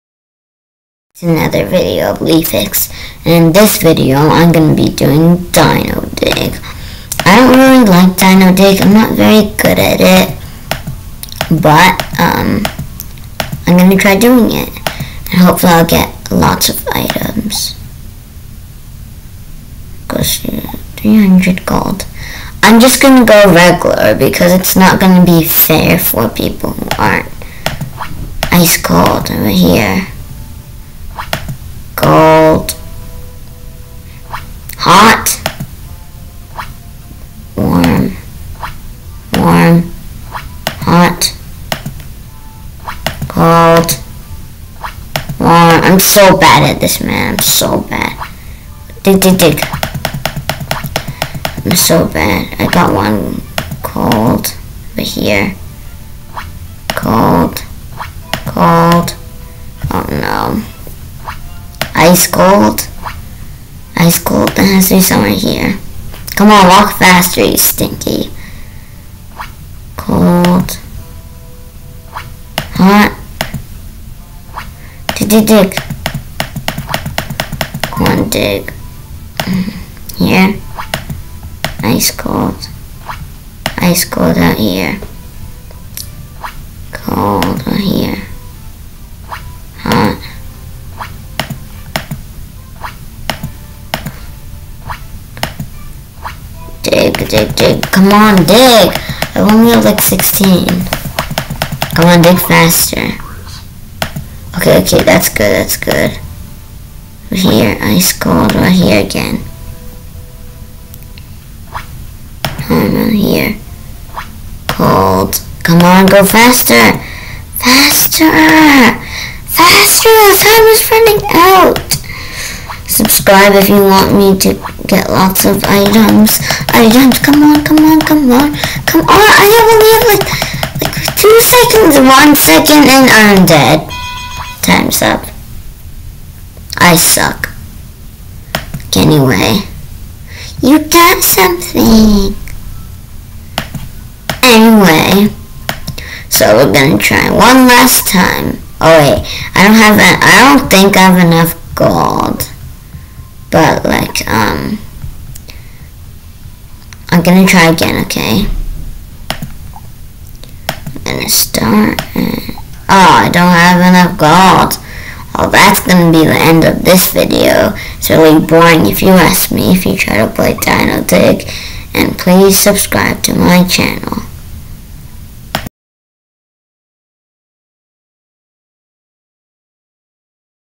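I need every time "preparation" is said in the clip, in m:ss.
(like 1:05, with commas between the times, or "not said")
not said.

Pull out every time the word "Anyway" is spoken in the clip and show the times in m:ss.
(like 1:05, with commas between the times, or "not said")
2:18, 2:24.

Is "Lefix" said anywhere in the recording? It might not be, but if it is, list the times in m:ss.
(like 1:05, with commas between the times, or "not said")
0:02.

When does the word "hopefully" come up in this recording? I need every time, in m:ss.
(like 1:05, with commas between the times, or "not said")
0:15.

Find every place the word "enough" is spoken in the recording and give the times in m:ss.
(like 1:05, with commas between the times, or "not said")
2:31, 2:43.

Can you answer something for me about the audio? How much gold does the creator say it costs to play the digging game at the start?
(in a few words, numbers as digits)
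300 gold.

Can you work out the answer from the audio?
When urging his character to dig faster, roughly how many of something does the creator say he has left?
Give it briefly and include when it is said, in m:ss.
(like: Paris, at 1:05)
16, at 1:40.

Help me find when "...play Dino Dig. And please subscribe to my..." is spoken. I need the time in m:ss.
2:50.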